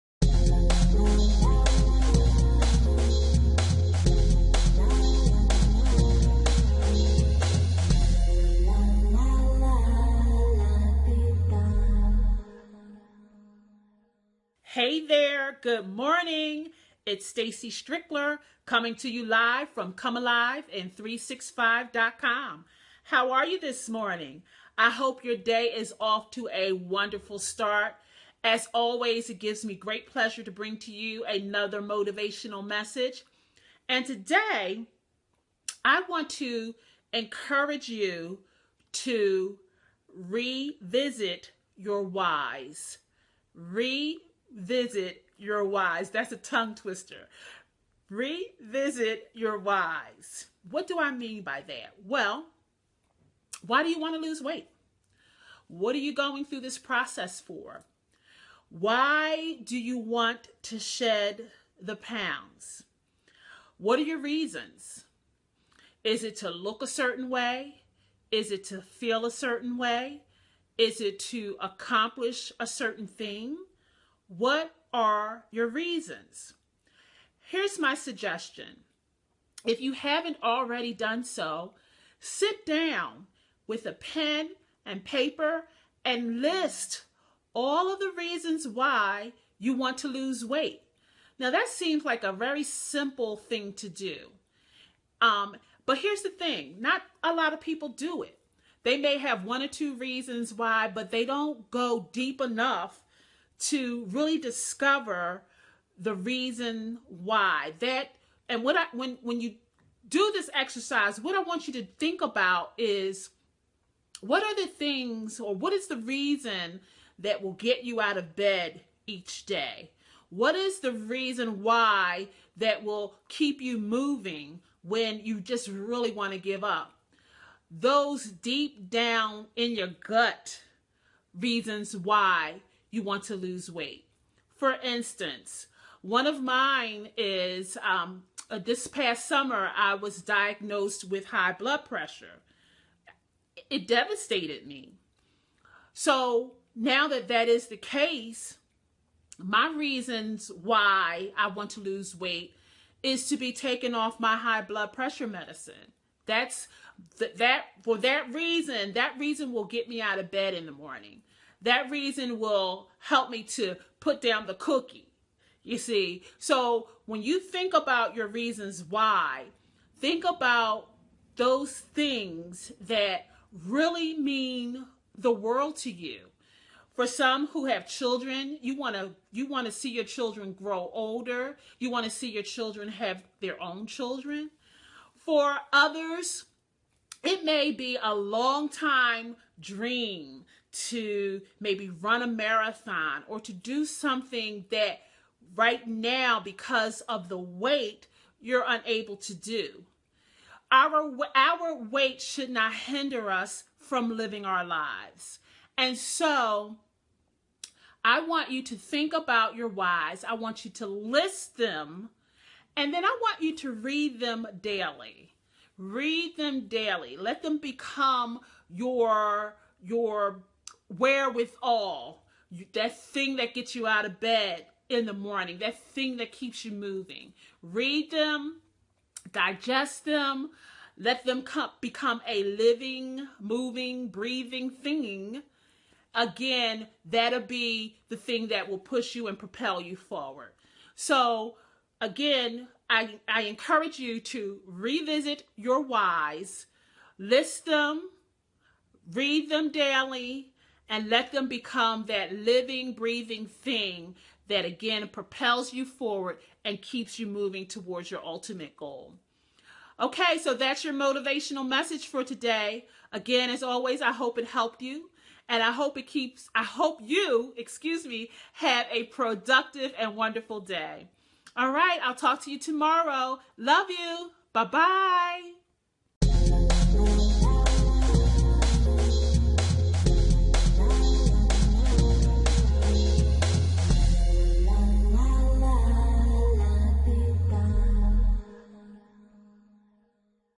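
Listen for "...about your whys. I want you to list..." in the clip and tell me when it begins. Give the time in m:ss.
3:29.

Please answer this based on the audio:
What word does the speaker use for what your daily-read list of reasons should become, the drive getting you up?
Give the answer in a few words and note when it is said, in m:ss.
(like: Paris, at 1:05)
wherewithal, at 3:40.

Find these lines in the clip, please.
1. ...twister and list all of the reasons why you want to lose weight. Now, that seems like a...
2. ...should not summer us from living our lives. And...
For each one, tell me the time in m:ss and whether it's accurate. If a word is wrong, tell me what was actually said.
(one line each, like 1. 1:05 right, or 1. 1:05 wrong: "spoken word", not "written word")
1. 1:25 wrong: "paper", not "twister"
2. 3:22 wrong: "hinder", not "summer".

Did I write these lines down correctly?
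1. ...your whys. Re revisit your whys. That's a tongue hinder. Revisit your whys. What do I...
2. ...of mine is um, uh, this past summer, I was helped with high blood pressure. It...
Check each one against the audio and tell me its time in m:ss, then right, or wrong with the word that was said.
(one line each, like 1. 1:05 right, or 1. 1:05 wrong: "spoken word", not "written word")
1. 0:41 wrong: "twister", not "hinder"
2. 2:16 wrong: "diagnosed", not "helped".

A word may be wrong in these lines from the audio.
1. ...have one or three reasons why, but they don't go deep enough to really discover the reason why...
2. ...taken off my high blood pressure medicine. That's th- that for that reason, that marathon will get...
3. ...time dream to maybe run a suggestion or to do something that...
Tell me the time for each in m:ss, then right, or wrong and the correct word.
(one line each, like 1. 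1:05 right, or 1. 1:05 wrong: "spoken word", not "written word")
1. 1:39 wrong: "two", not "three"
2. 2:33 wrong: "reason", not "marathon"
3. 3:08 wrong: "marathon", not "suggestion".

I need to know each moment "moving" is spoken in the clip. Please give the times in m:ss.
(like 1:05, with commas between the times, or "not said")
2:03, 3:46, 3:53, 4:17.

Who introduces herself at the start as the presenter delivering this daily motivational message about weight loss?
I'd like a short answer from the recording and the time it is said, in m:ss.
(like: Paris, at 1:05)
Stacy Strickler, at 0:17.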